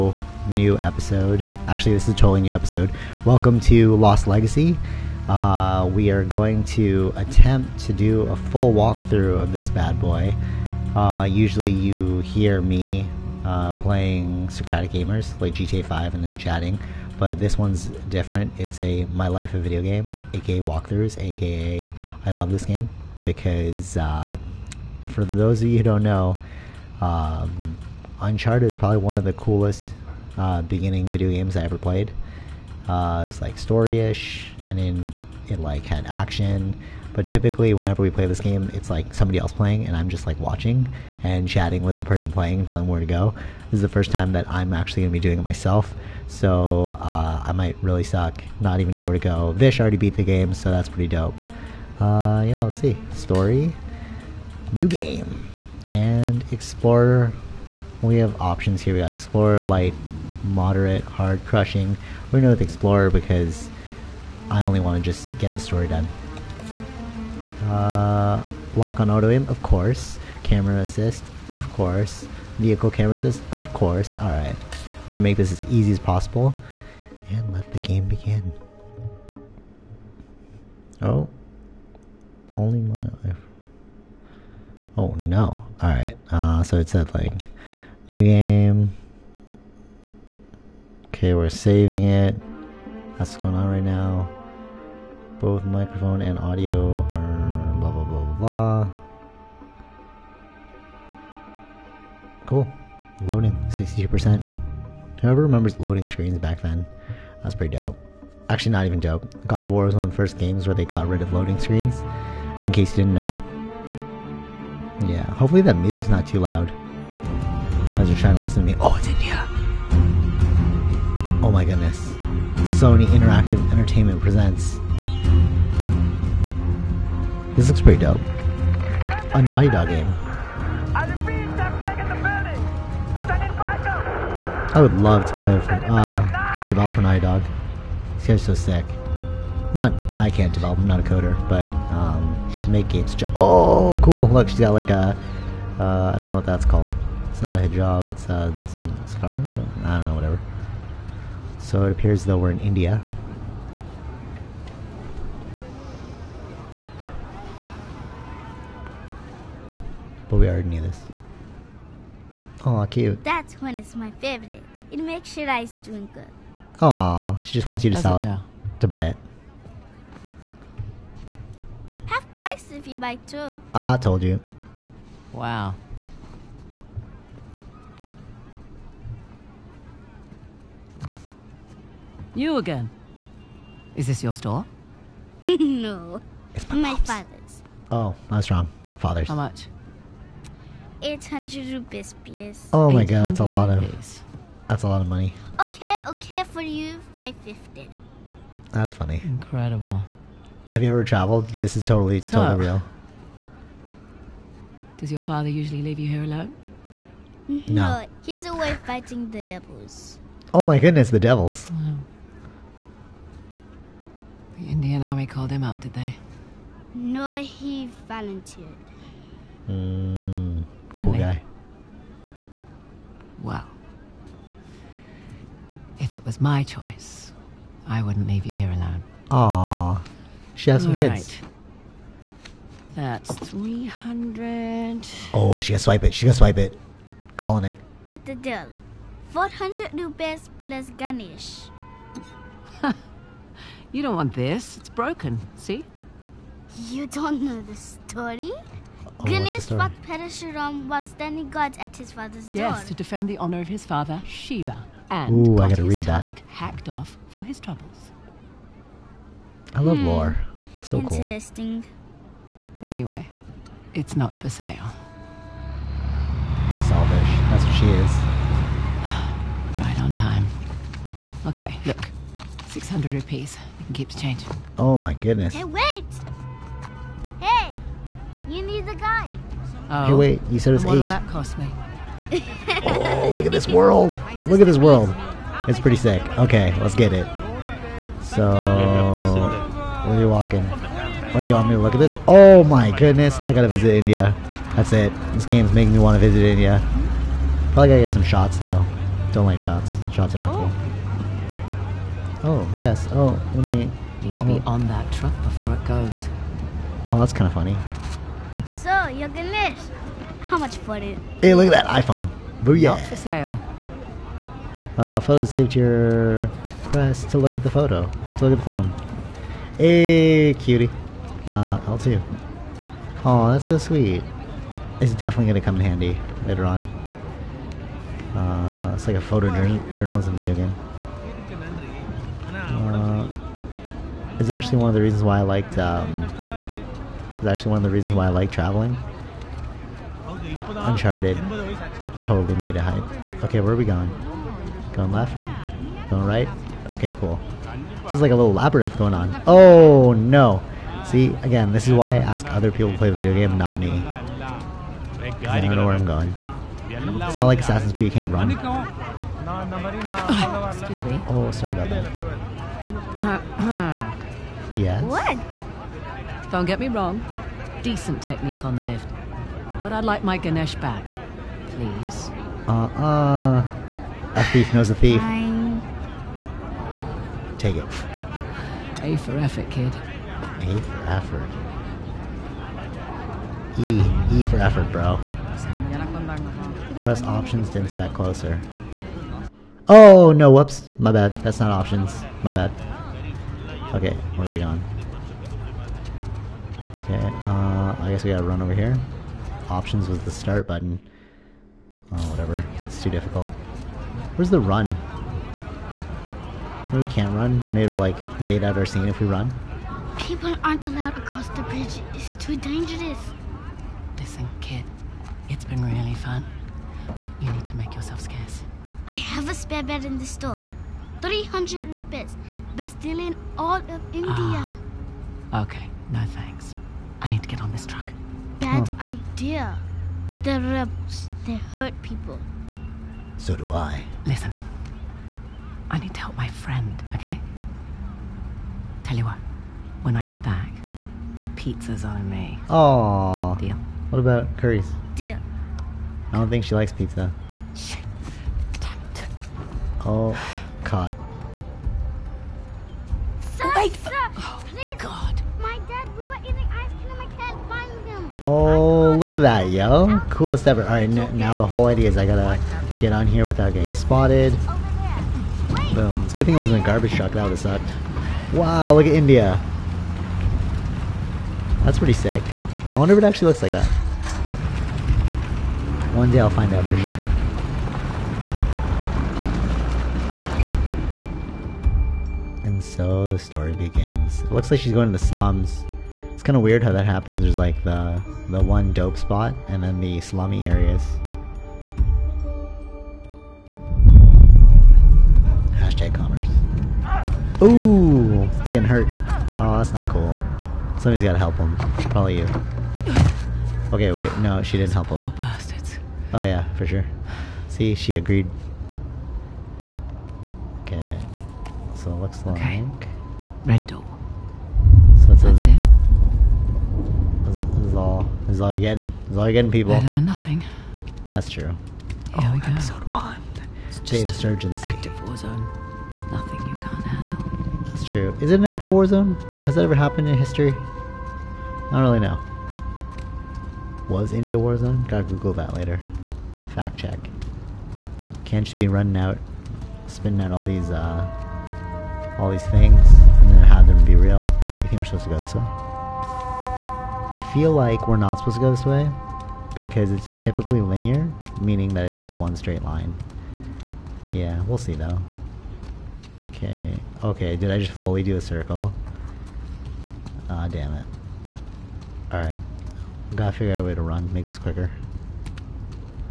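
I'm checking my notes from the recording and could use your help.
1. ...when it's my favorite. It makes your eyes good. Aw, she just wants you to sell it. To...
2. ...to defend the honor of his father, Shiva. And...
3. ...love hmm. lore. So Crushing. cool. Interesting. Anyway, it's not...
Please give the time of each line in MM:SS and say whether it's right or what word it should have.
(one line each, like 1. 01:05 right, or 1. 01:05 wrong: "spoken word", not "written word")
1. 02:43 right
2. 04:12 right
3. 04:19 wrong: "Interesting", not "Crushing".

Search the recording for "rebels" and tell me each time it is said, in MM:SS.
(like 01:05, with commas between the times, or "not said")
07:10.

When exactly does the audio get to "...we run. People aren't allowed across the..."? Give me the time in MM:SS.
06:49.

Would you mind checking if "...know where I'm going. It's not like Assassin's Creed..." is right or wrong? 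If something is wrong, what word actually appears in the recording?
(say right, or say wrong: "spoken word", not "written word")
right.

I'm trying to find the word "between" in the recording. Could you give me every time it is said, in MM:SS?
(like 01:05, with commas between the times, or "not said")
not said.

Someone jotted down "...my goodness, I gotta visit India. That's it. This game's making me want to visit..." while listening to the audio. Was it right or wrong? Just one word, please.
right.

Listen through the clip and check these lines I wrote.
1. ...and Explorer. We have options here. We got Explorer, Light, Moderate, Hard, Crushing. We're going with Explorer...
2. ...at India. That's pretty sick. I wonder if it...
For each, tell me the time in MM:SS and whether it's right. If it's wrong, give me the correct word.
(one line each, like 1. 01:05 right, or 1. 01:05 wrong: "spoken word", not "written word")
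1. 00:55 right
2. 07:49 right.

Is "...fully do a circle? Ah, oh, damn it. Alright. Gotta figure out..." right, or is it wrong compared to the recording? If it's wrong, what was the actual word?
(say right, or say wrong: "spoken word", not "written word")
right.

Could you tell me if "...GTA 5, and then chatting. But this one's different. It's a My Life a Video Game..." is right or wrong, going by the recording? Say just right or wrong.
right.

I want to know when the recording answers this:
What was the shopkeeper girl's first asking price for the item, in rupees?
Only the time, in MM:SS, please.
03:11.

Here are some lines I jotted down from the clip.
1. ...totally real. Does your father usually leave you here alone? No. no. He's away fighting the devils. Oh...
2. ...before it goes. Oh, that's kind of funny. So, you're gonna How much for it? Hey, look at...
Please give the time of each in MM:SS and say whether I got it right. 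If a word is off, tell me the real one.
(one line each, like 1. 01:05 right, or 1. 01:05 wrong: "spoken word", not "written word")
1. 03:22 right
2. 05:05 right.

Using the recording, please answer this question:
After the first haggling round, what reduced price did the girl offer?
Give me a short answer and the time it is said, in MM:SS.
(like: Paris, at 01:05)
550, at 03:17.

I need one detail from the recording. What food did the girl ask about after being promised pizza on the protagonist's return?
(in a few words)
Curries.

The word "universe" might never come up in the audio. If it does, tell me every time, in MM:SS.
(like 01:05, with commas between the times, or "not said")
not said.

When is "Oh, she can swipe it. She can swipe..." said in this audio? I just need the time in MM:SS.
03:55.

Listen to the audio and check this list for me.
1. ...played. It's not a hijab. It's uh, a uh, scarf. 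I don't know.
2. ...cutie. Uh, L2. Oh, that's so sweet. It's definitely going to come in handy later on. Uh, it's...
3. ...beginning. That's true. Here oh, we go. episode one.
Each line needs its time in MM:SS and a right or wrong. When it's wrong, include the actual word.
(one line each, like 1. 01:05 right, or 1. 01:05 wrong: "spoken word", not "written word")
1. 02:26 wrong: "called", not "played"
2. 05:20 right
3. 08:40 wrong: "nothing", not "beginning".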